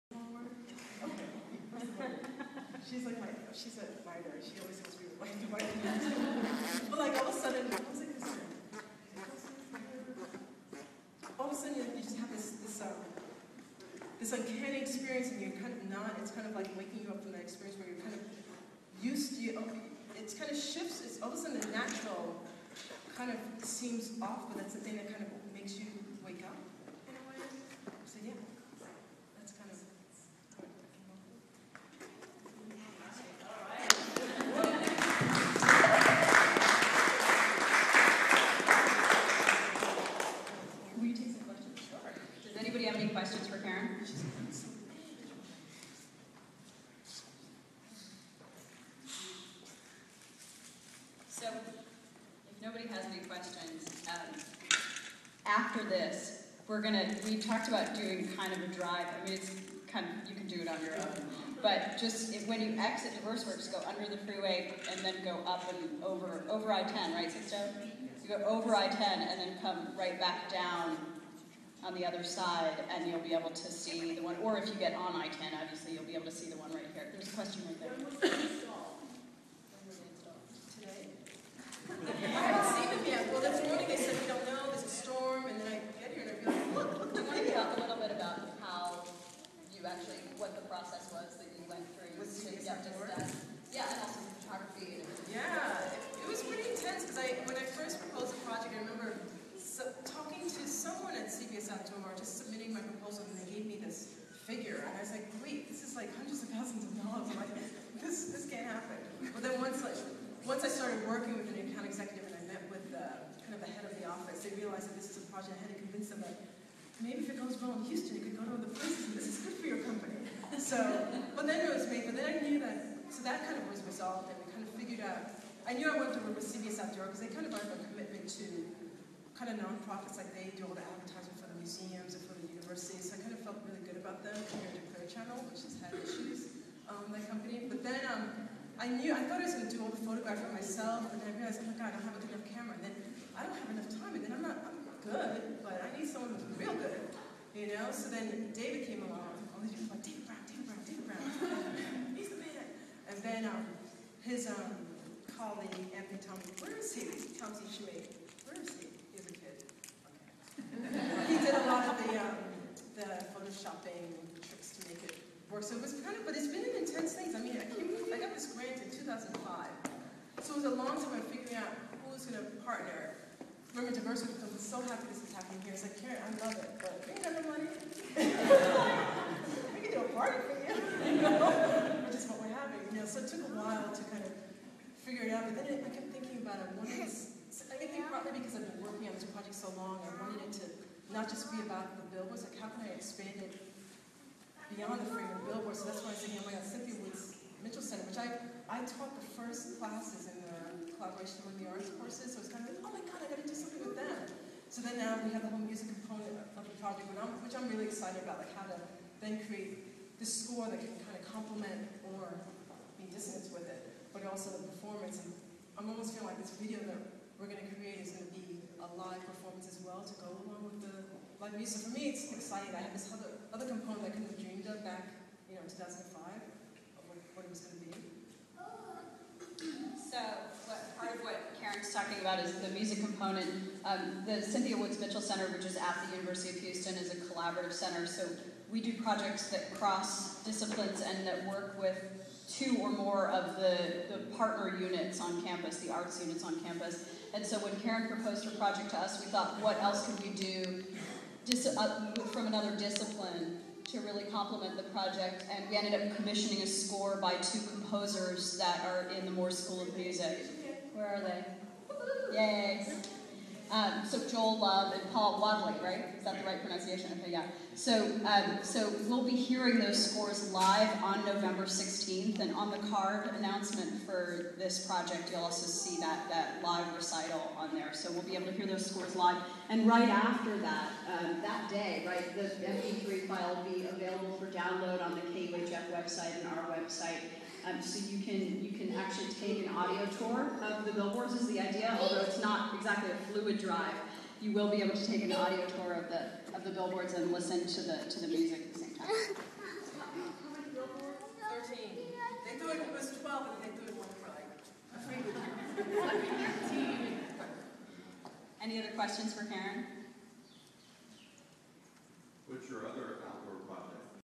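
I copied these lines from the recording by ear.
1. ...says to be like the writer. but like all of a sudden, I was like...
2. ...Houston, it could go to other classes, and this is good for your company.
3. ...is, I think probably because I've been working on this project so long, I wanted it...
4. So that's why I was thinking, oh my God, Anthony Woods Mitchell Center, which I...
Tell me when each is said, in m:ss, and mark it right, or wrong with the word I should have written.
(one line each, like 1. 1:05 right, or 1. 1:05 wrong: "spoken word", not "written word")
1. 0:04 right
2. 1:57 wrong: "places", not "classes"
3. 3:06 right
4. 3:15 wrong: "Cynthia", not "Anthony".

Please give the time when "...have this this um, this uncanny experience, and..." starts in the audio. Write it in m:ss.
0:12.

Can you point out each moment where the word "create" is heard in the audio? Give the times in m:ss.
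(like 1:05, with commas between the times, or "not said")
3:29, 3:37.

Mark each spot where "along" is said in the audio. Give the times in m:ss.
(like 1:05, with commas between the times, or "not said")
2:29, 3:40.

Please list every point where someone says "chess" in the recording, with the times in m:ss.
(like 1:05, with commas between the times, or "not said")
not said.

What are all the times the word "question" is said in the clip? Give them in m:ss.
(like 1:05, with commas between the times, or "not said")
1:17, 5:08.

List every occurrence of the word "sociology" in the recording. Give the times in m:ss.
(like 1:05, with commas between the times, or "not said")
not said.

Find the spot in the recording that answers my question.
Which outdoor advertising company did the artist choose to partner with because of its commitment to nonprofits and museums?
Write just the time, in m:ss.
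2:06.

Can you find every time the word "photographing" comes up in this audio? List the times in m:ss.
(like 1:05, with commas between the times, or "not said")
2:20.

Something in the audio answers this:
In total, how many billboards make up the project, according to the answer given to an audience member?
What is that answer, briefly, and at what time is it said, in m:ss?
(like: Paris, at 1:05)
13, at 5:01.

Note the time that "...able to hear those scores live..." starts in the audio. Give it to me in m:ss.
4:38.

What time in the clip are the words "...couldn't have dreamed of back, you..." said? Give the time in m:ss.
3:44.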